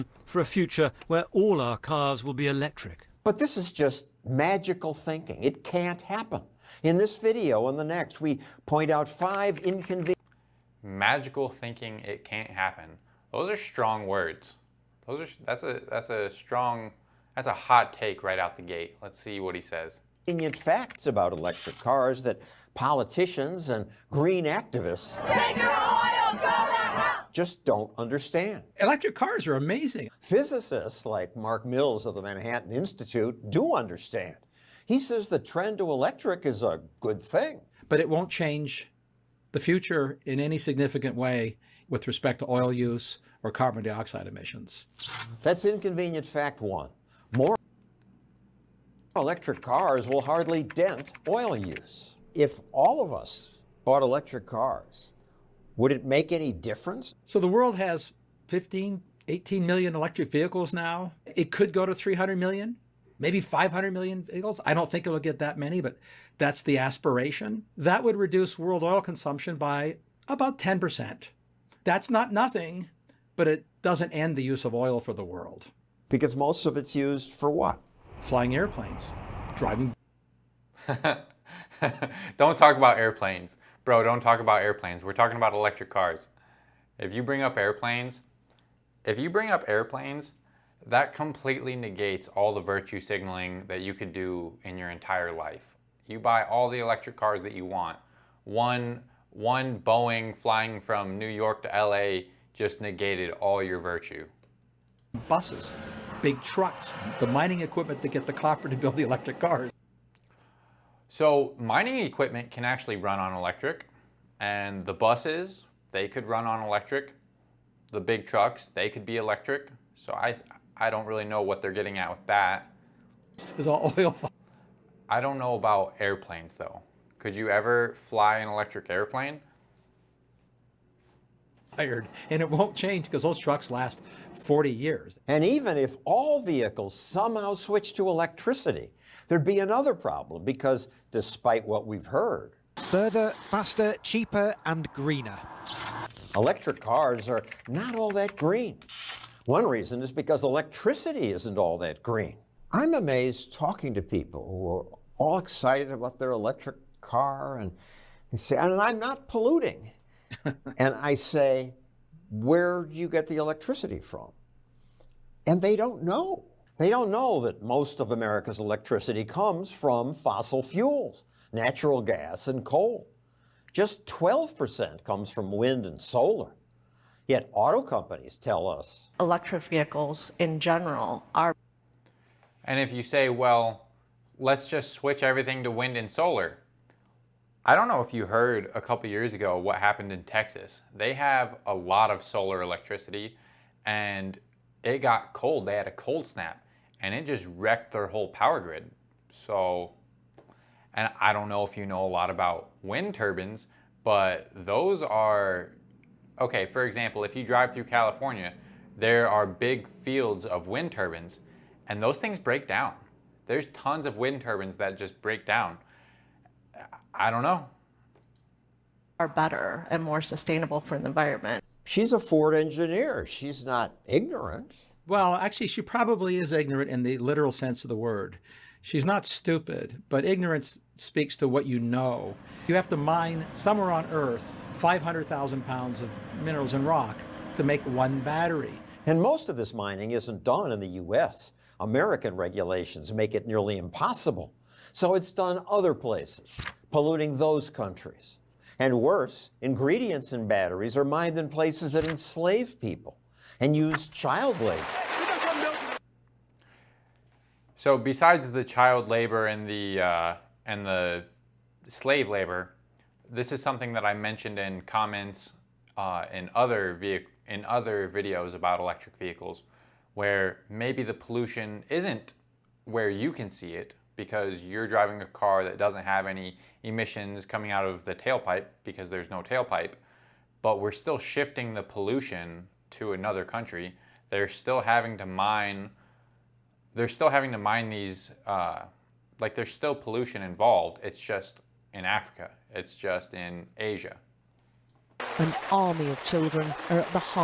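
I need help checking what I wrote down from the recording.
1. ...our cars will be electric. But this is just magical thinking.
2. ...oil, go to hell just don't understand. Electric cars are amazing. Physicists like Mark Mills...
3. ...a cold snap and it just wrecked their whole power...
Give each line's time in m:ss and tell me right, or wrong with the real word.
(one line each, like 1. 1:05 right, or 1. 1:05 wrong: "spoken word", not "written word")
1. 0:01 right
2. 0:25 right
3. 3:15 right.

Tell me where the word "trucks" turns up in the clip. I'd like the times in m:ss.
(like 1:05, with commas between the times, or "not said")
1:46, 1:58, 2:13.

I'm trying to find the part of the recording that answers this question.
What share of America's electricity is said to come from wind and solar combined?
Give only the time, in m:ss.
2:54.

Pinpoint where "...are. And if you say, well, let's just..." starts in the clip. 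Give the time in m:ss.
3:01.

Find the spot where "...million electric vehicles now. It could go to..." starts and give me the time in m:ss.
0:59.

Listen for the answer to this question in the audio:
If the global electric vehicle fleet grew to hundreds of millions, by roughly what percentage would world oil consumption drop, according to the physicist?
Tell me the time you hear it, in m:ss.
1:10.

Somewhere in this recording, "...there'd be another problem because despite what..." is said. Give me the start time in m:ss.
2:19.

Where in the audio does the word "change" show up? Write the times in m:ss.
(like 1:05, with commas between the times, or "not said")
0:38, 2:12.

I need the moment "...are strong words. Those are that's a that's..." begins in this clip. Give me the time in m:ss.
0:13.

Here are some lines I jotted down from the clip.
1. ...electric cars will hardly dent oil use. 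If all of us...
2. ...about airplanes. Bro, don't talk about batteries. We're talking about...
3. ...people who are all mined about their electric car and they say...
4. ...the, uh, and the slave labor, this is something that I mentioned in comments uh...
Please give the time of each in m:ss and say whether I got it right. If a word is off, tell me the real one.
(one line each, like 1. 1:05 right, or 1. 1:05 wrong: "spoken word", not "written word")
1. 0:49 right
2. 1:22 wrong: "airplanes", not "batteries"
3. 2:34 wrong: "excited", not "mined"
4. 4:19 right.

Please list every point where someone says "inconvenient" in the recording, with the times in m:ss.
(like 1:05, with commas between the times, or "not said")
0:09, 0:45.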